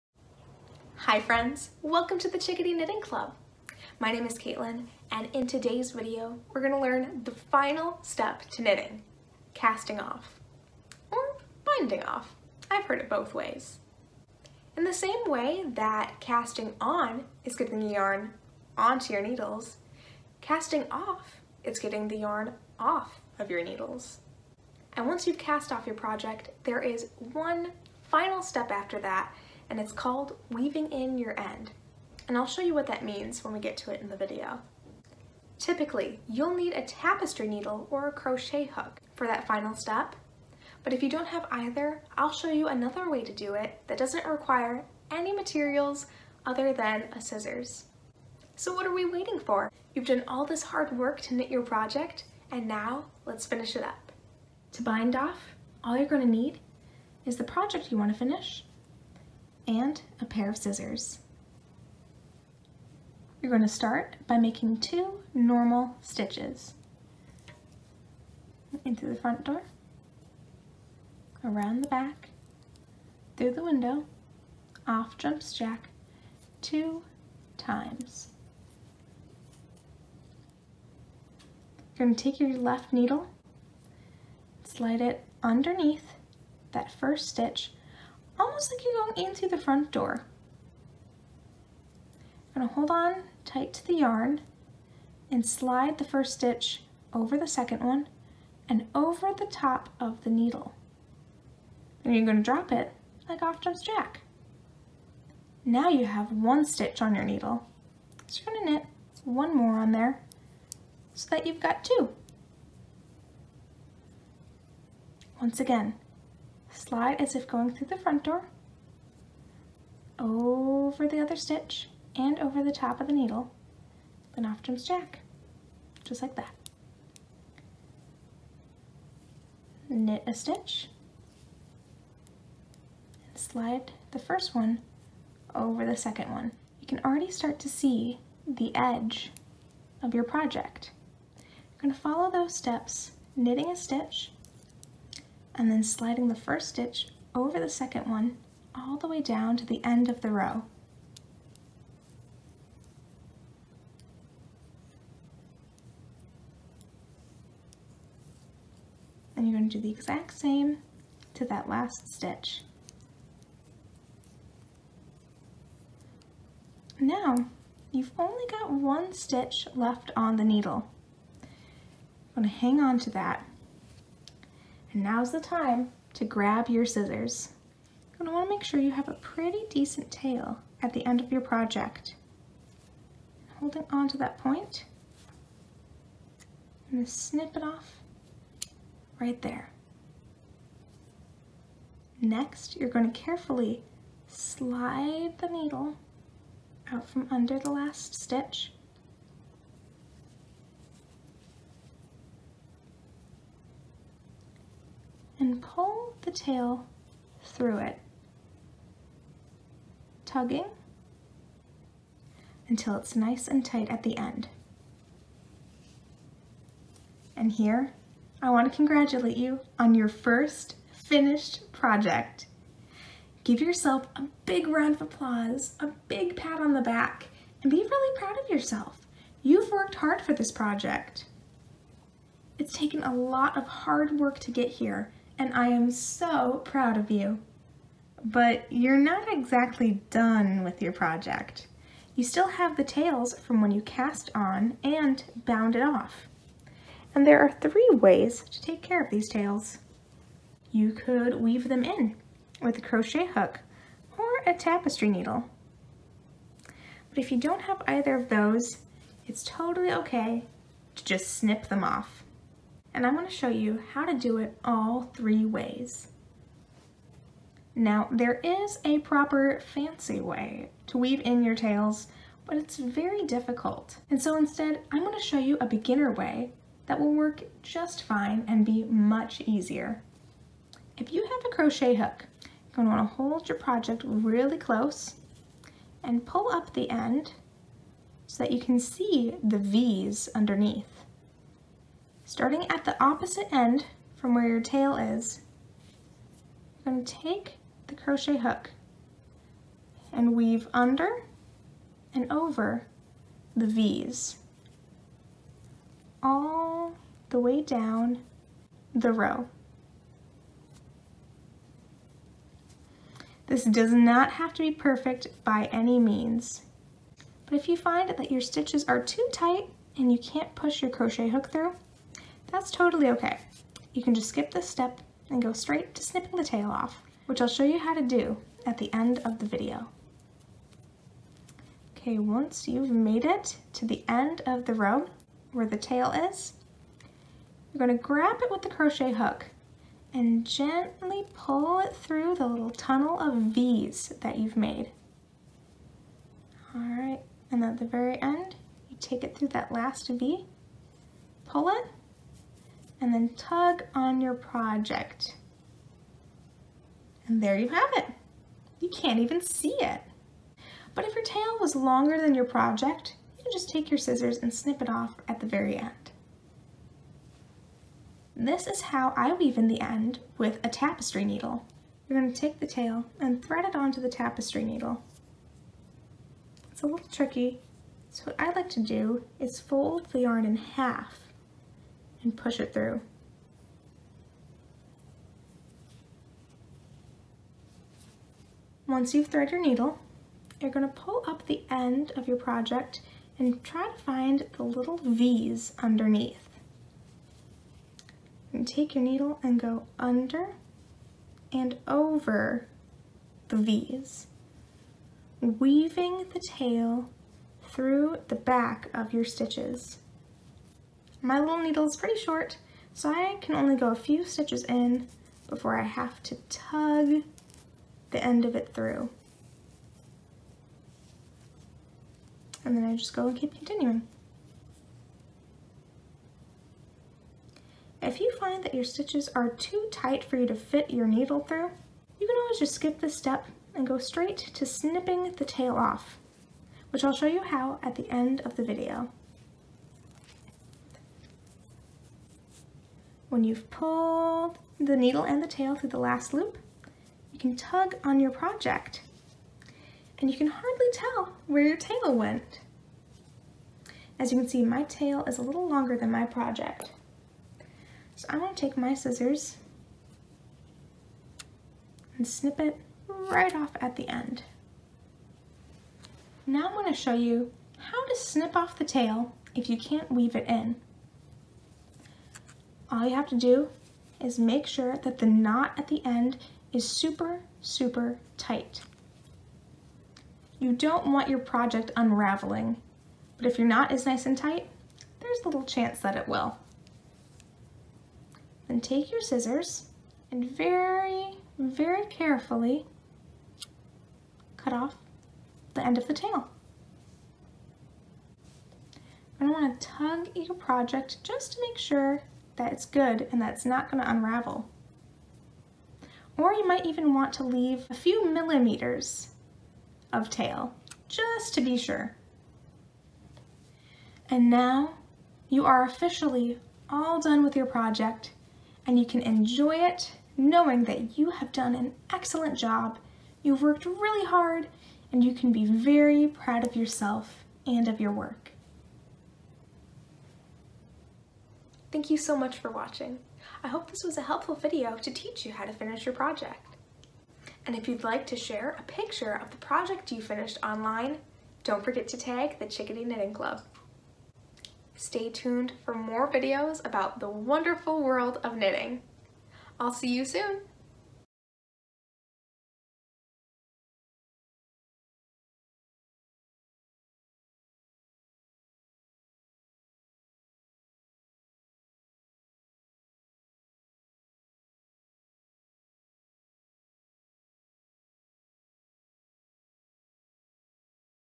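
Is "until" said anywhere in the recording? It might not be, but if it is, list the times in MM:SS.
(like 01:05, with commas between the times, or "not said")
03:32.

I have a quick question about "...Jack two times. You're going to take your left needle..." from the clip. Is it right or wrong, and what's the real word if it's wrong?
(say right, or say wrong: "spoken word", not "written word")
right.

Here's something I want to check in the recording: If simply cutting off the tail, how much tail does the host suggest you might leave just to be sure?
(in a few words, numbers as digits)
A few millimeters.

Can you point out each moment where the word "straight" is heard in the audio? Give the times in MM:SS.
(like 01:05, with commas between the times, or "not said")
05:25, 07:13.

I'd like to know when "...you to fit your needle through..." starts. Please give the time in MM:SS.
07:10.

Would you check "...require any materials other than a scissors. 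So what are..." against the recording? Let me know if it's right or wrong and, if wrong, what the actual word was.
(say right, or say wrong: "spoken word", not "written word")
right.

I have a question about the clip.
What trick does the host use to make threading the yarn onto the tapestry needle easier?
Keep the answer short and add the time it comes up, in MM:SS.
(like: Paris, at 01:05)
Fold the yarn in half, at 06:19.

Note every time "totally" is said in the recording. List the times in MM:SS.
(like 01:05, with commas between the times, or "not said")
04:19, 05:22.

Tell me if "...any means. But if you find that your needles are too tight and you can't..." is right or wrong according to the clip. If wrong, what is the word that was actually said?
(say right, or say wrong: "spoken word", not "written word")
wrong: "stitches", not "needles".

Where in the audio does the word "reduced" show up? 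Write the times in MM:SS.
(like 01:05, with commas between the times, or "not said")
not said.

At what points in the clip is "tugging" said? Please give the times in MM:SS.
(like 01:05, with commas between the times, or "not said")
03:30.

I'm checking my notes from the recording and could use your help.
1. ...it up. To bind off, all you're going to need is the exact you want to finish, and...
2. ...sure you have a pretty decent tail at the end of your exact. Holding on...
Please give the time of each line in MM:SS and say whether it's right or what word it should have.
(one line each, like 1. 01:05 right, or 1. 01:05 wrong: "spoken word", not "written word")
1. 00:53 wrong: "project", not "exact"
2. 02:58 wrong: "project", not "exact".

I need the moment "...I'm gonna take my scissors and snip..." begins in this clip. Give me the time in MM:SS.
07:38.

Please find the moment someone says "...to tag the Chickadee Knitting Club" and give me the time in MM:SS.
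09:02.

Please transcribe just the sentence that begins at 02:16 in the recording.
You can already start to see the edge of your project.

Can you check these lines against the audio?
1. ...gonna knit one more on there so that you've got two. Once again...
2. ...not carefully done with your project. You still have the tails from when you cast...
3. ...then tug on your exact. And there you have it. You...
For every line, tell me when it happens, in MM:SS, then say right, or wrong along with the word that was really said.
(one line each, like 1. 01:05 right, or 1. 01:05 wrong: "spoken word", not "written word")
1. 01:48 right
2. 03:58 wrong: "exactly", not "carefully"
3. 05:53 wrong: "project", not "exact".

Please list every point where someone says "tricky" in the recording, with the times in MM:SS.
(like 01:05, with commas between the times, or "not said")
06:17.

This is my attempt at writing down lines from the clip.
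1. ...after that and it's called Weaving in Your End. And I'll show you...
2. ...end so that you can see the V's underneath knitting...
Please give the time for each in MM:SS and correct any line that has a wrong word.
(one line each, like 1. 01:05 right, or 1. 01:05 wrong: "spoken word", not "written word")
1. 00:28 right
2. 04:46 wrong: "starting", not "knitting".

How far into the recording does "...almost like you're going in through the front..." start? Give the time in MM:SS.
01:28.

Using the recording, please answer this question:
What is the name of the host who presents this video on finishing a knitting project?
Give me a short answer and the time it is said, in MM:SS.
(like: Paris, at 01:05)
Caitlin, at 00:04.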